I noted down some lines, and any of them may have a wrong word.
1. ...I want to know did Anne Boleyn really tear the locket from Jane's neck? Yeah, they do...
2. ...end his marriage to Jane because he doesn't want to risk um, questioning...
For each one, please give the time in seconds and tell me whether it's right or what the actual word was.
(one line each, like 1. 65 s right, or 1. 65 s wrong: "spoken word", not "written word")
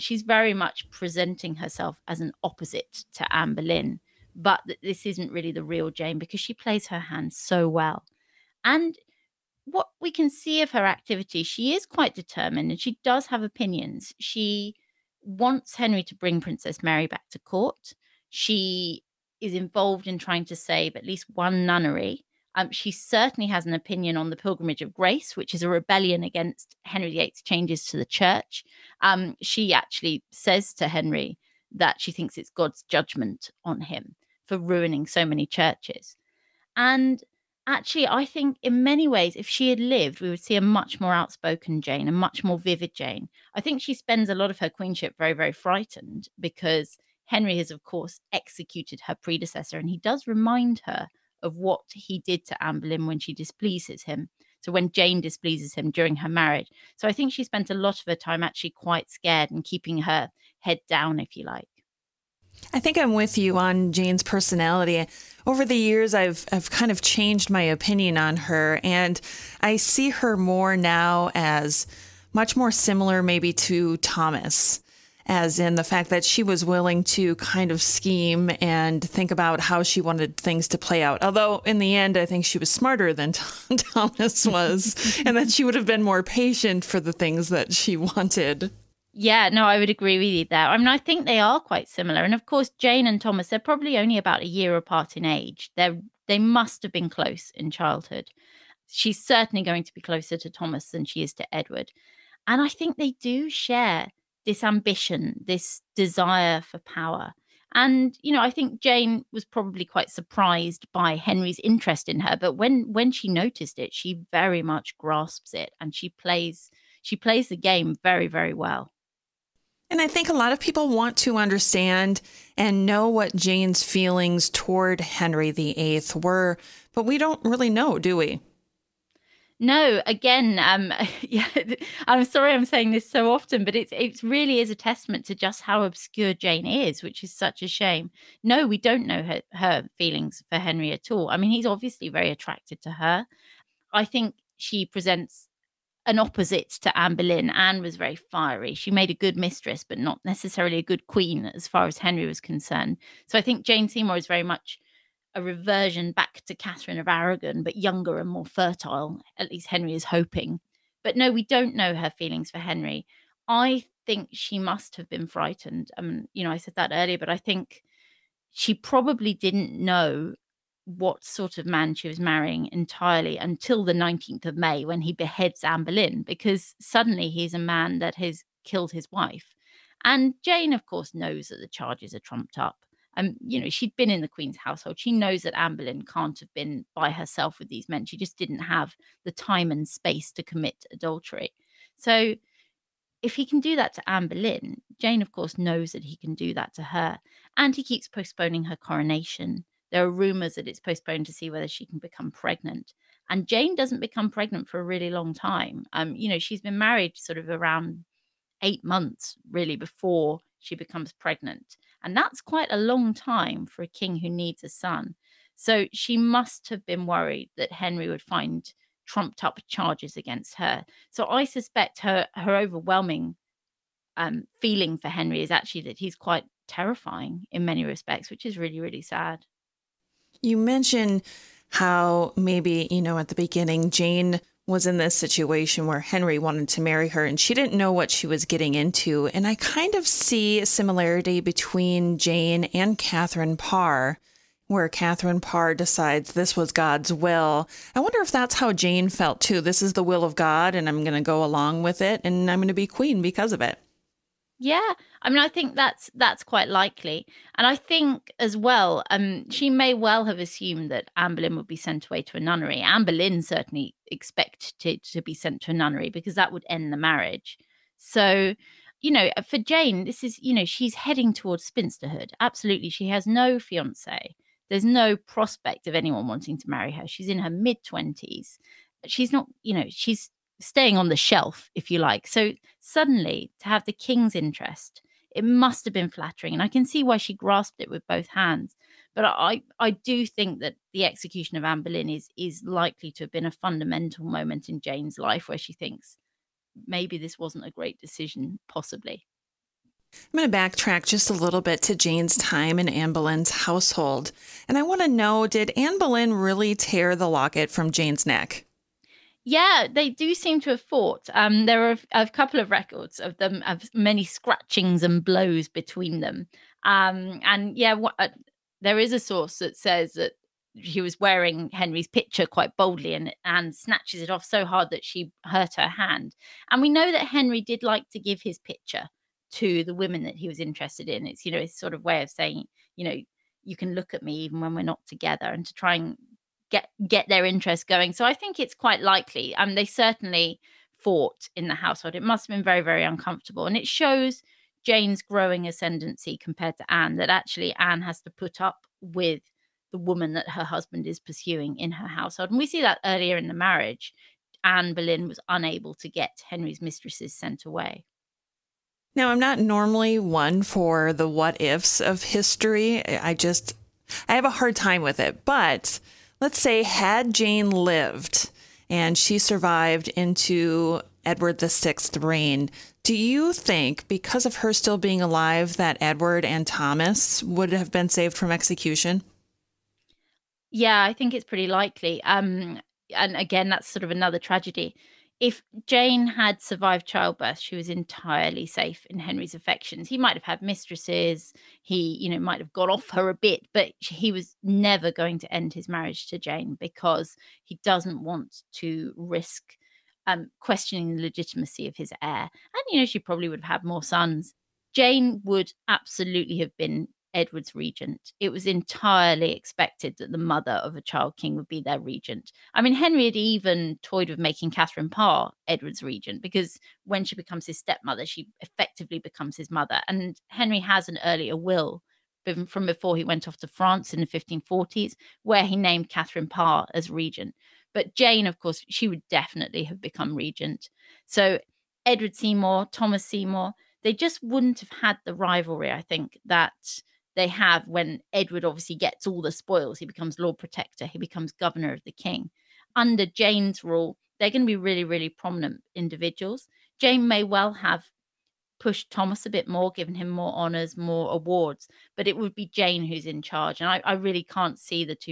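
1. 304 s right
2. 395 s right.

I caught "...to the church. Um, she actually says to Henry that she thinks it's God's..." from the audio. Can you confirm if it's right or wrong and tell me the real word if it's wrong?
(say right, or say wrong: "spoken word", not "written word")
right.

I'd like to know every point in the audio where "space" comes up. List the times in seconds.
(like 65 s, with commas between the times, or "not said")
189 s.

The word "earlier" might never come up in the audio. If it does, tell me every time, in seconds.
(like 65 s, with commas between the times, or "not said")
166 s, 353 s, 421 s.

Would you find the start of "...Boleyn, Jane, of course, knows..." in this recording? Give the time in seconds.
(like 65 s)
194 s.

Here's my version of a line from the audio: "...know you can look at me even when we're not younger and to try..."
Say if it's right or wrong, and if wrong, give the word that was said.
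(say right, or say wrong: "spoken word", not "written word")
wrong: "together", not "younger".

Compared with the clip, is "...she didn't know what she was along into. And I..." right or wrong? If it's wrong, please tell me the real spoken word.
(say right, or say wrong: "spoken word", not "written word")
wrong: "getting", not "along".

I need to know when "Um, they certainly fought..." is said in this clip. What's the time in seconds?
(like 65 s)
339 s.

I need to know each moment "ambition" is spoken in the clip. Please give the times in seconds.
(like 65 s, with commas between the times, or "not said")
104 s.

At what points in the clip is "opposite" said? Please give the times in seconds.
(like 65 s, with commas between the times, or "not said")
2 s, 146 s.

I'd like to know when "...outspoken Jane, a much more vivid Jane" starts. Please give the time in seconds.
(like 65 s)
41 s.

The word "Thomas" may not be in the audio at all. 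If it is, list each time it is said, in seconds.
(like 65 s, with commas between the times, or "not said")
73 s, 83 s, 93 s, 100 s, 376 s, 432 s, 449 s.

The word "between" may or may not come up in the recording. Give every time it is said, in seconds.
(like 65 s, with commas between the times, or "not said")
241 s, 315 s.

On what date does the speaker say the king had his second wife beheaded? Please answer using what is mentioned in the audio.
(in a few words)
19th of May.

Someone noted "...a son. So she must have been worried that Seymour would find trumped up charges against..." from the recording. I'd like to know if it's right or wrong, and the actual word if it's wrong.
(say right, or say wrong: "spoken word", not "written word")
wrong: "Henry", not "Seymour".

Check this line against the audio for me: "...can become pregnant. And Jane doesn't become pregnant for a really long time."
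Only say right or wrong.
right.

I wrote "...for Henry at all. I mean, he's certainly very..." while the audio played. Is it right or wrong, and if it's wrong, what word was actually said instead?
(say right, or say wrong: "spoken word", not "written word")
wrong: "obviously", not "certainly".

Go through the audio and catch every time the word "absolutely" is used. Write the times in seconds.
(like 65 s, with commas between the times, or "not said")
272 s, 405 s.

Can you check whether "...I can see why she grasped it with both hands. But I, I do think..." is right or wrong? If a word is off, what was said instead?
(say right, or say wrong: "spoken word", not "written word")
right.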